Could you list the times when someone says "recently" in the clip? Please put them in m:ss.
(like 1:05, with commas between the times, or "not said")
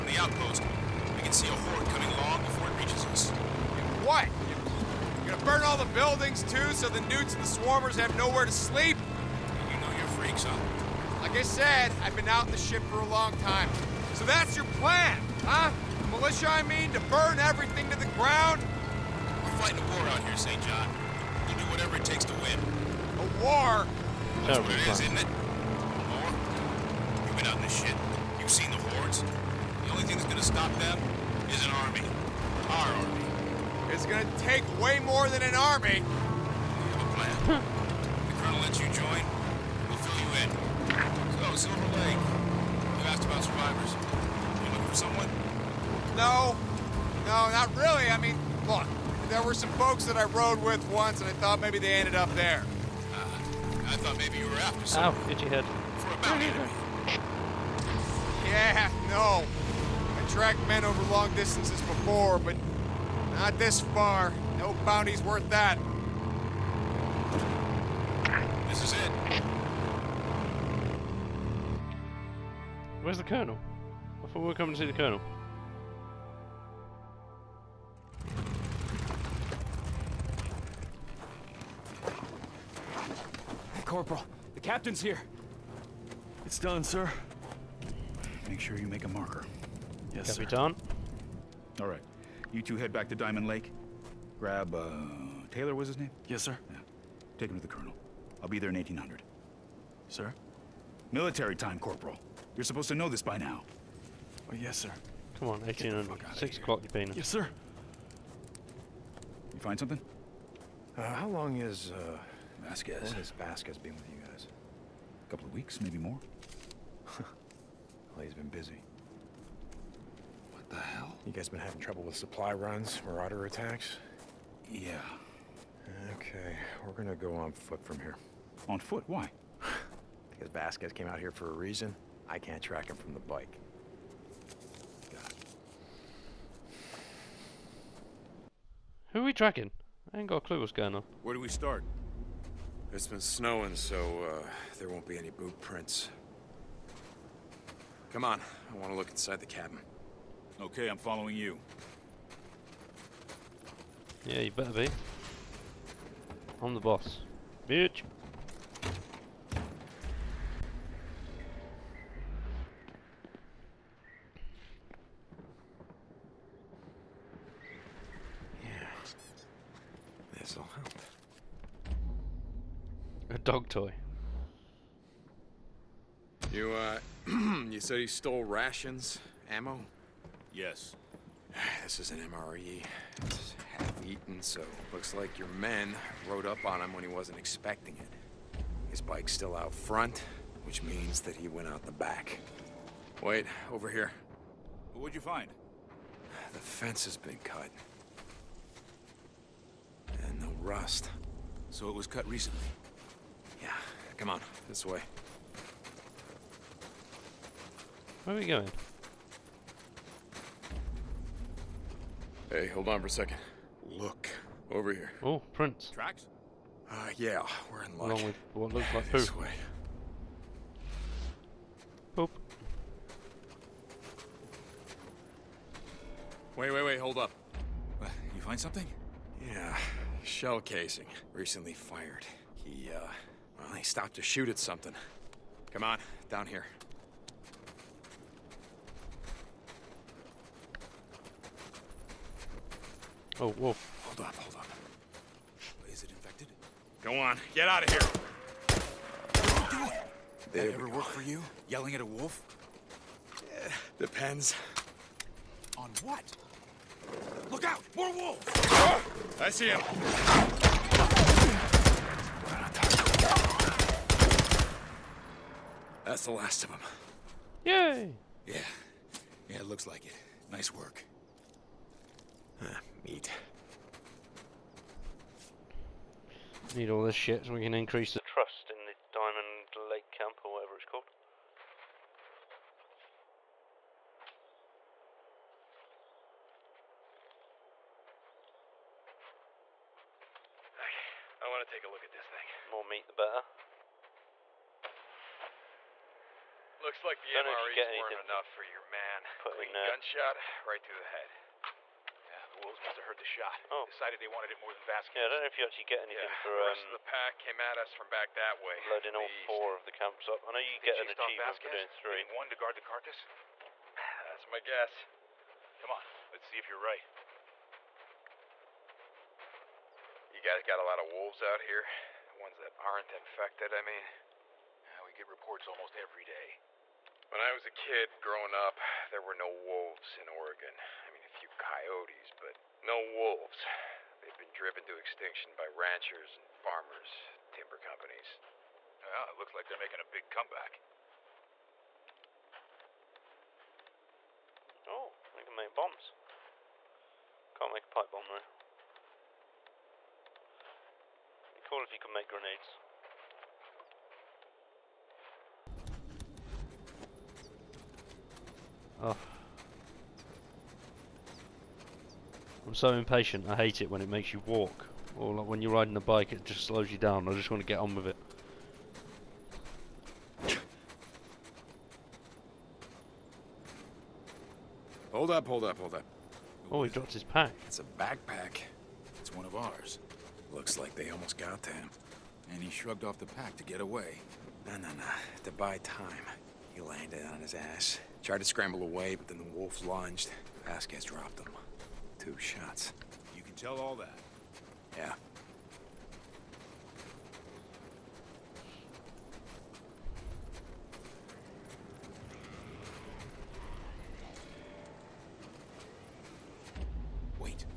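3:22, 3:51.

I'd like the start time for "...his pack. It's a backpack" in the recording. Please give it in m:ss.
6:17.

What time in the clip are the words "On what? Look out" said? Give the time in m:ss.
4:15.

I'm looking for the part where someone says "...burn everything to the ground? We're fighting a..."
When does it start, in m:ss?
0:17.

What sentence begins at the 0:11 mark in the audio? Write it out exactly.
Like I said, I've been out in the ship for a long time.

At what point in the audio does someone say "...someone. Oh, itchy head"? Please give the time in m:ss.
0:54.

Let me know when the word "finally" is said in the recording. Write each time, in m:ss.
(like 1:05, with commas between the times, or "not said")
not said.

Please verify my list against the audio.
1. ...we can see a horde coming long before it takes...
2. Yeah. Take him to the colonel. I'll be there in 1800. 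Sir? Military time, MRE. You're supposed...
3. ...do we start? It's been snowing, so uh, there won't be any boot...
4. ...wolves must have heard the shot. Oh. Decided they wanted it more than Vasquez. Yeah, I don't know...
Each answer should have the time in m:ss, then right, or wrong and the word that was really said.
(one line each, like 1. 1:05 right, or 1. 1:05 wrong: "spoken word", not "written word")
1. 0:01 wrong: "reaches", not "takes"
2. 1:36 wrong: "Corporal", not "MRE"
3. 2:21 right
4. 5:02 right.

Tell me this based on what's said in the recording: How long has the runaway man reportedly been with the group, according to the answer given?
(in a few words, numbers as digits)
A couple of weeks.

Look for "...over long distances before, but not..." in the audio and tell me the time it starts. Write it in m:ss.
1:00.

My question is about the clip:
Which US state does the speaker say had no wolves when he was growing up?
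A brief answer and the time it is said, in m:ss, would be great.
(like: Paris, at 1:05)
Oregon, at 5:30.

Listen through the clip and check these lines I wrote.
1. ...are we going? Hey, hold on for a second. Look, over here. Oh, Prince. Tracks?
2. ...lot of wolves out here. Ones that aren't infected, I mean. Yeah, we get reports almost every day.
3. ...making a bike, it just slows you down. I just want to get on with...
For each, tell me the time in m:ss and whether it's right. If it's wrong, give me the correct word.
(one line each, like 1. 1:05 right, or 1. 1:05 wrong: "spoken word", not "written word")
1. 3:28 right
2. 5:20 right
3. 6:05 wrong: "riding", not "making".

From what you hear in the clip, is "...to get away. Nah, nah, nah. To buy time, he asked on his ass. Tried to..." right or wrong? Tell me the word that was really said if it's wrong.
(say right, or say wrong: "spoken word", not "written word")
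wrong: "landed", not "asked".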